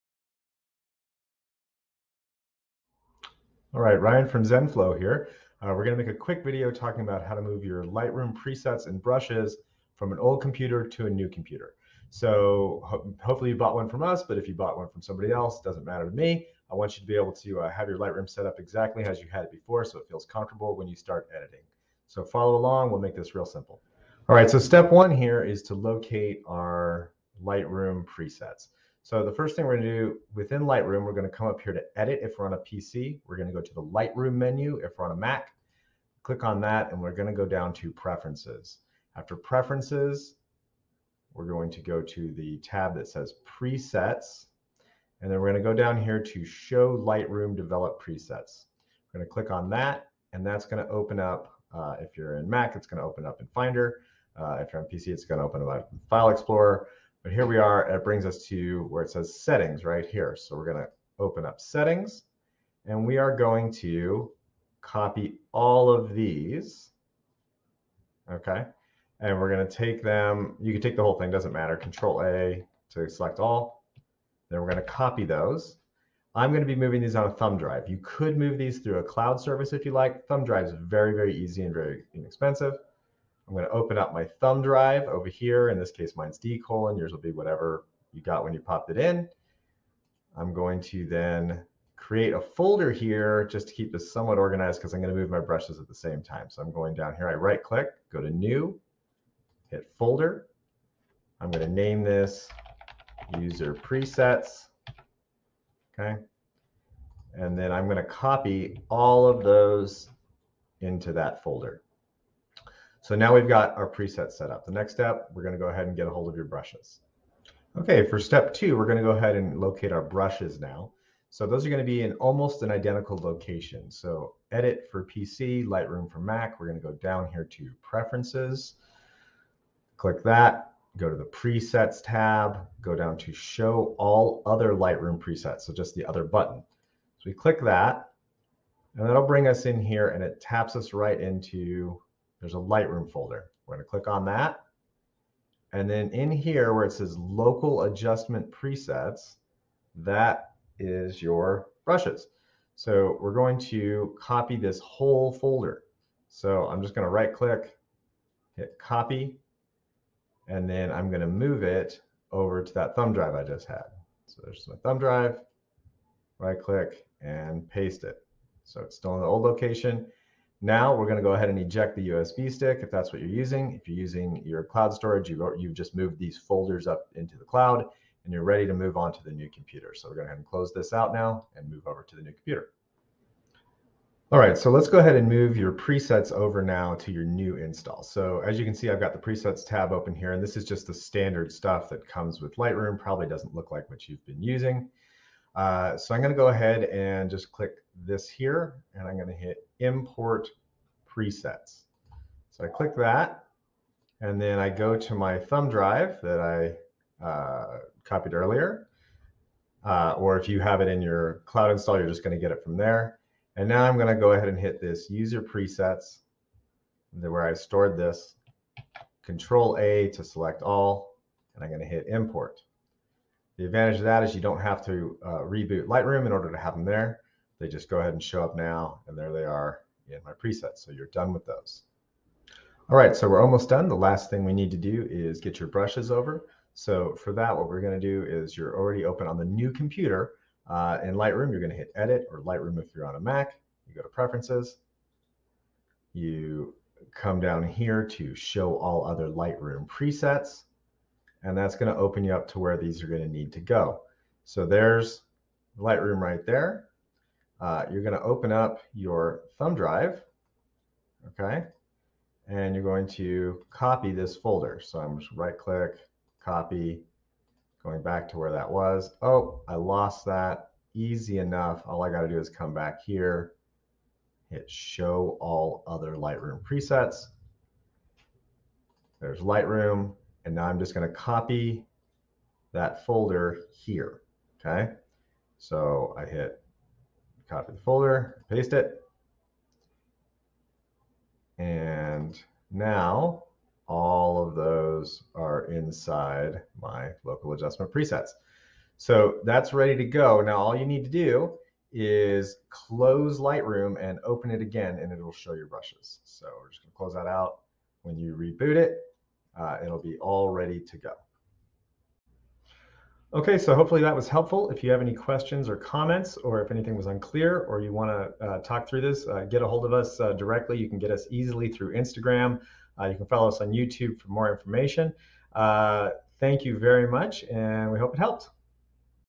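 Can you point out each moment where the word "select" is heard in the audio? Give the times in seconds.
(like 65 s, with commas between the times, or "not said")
73 s, 220 s.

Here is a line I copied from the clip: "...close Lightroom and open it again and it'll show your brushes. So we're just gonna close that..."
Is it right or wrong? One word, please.
right.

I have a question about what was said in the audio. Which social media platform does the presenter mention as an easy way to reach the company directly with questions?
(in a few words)
Instagram.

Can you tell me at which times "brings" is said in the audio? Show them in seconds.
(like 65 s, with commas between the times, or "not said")
58 s, 139 s.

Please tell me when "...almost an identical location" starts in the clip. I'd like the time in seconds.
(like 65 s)
122 s.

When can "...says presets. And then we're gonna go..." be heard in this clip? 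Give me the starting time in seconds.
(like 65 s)
43 s.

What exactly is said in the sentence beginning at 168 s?
So it's still in the old location.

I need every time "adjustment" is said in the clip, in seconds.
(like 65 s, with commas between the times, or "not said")
147 s, 297 s.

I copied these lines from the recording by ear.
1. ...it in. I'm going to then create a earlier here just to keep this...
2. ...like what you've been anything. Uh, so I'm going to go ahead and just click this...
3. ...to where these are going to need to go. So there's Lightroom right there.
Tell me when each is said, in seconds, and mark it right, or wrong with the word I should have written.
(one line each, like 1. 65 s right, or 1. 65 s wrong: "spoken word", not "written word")
1. 88 s wrong: "folder", not "earlier"
2. 193 s wrong: "using", not "anything"
3. 252 s right.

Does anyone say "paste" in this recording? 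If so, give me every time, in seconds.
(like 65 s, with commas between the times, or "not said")
167 s, 288 s.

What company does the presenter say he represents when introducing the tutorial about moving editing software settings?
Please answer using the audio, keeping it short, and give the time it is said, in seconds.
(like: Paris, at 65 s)
ZenFlow, at 4 s.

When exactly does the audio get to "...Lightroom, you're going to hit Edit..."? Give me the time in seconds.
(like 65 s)
241 s.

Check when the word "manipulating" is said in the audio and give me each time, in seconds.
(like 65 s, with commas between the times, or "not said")
not said.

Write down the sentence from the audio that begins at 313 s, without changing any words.
Okay, so hopefully that was helpful.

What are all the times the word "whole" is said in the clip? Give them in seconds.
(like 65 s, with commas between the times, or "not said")
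71 s, 154 s.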